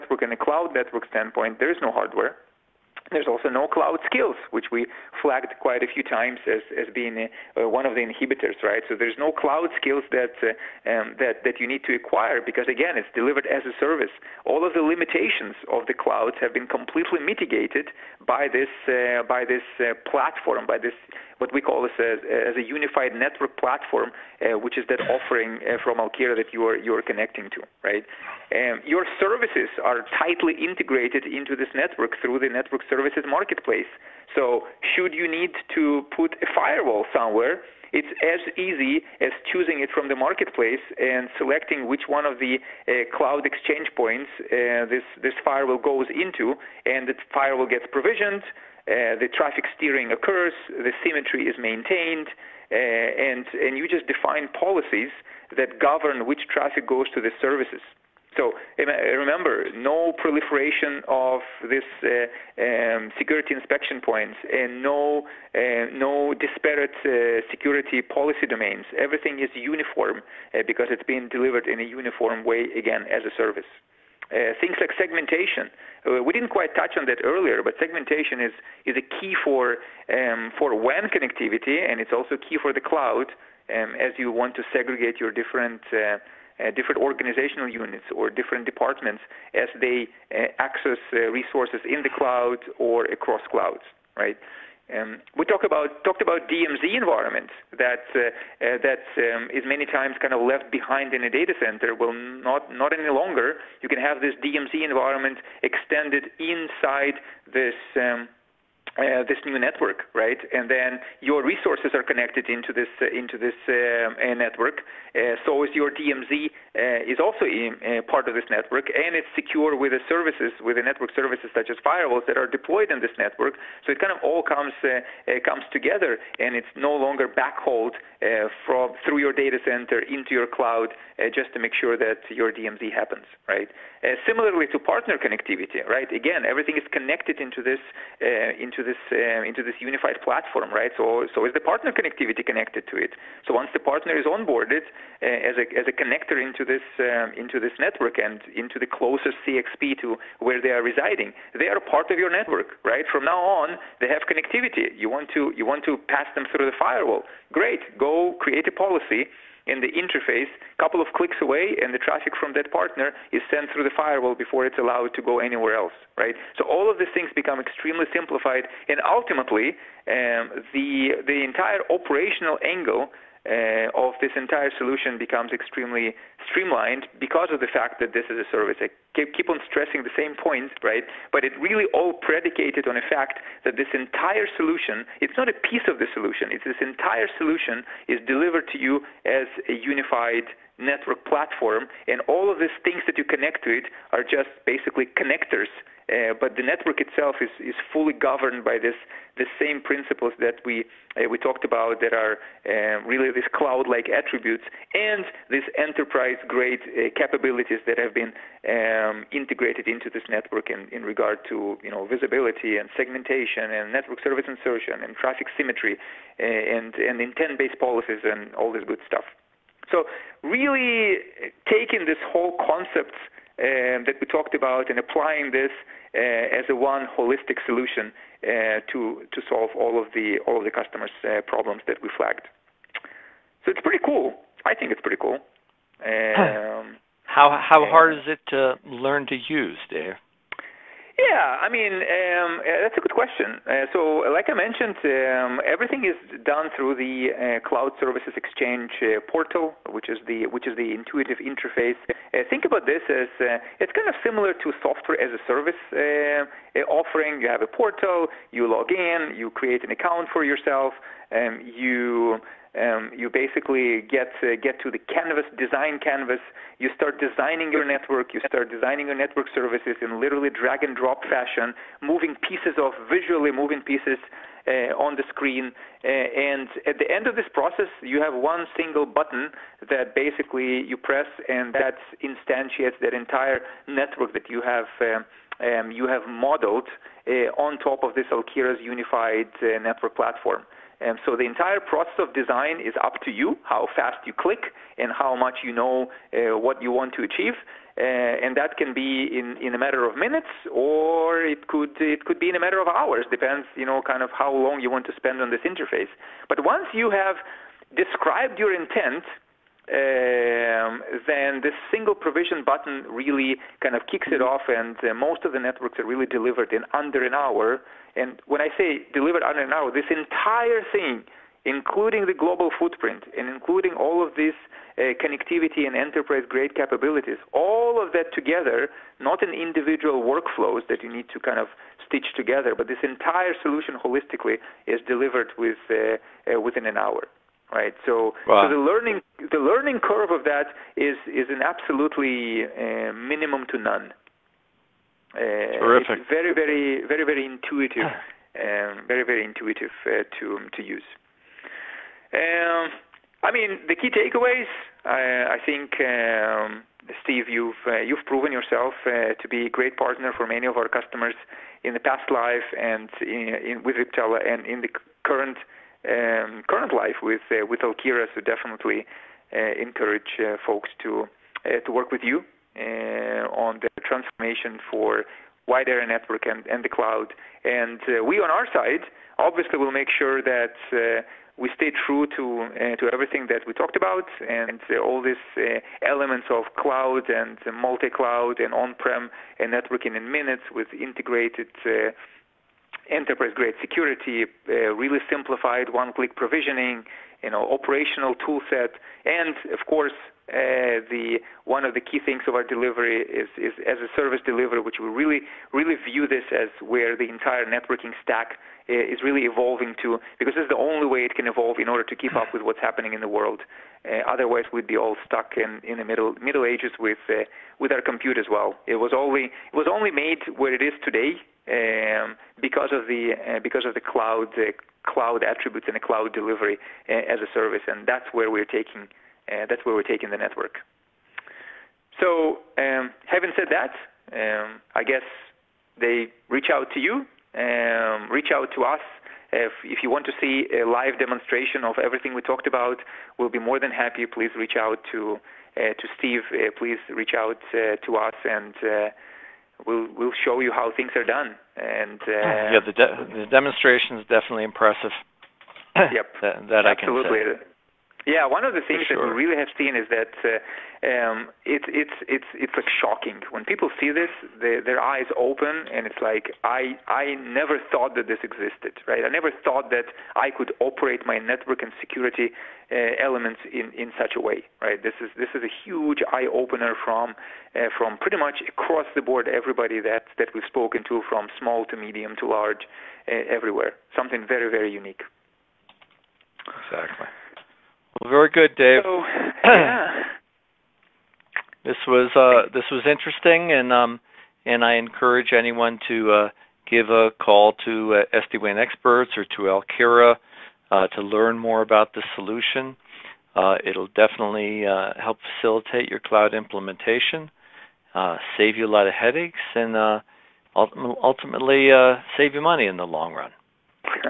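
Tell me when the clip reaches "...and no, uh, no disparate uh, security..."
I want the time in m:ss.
1:04.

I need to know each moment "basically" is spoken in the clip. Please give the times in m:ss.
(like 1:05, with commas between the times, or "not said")
3:14, 4:23, 4:40.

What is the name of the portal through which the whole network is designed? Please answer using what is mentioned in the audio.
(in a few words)
Cloud Services Exchange.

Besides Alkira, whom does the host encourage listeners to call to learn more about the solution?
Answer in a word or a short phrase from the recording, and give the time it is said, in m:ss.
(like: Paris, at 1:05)
SD-WAN experts, at 8:18.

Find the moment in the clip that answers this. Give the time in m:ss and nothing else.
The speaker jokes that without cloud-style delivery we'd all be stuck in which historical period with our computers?
6:56.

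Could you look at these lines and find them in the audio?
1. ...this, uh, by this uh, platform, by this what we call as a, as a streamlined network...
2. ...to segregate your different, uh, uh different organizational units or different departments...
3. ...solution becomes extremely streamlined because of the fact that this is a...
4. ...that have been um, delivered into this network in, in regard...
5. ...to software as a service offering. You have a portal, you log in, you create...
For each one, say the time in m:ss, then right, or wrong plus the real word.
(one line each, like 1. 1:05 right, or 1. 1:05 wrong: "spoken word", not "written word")
1. 0:18 wrong: "unified", not "streamlined"
2. 1:24 right
3. 2:54 right
4. 3:27 wrong: "integrated", not "delivered"
5. 4:14 right.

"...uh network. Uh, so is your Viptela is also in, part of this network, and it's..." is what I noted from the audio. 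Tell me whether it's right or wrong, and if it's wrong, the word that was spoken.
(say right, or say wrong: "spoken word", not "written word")
wrong: "DMZ", not "Viptela".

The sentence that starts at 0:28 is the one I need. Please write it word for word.
Um, your services are tightly integrated into this network through the network services marketplace.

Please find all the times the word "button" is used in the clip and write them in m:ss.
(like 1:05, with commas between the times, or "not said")
4:39, 5:12.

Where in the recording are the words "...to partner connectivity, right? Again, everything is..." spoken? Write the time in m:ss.
2:14.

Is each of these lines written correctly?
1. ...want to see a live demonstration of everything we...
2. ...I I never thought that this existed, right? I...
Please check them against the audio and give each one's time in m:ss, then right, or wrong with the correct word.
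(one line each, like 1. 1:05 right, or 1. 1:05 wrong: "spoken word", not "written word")
1. 7:20 right
2. 7:46 right.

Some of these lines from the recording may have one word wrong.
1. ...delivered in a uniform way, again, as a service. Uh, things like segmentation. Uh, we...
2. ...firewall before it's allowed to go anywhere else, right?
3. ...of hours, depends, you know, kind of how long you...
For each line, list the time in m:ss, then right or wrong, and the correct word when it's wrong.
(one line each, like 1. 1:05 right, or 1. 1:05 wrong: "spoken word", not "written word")
1. 1:11 right
2. 2:43 right
3. 5:02 right.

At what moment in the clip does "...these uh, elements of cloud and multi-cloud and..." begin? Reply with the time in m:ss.
6:25.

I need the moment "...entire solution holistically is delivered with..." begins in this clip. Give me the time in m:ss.
5:33.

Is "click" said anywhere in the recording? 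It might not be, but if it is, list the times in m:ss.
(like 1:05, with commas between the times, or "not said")
2:41, 4:54, 6:35.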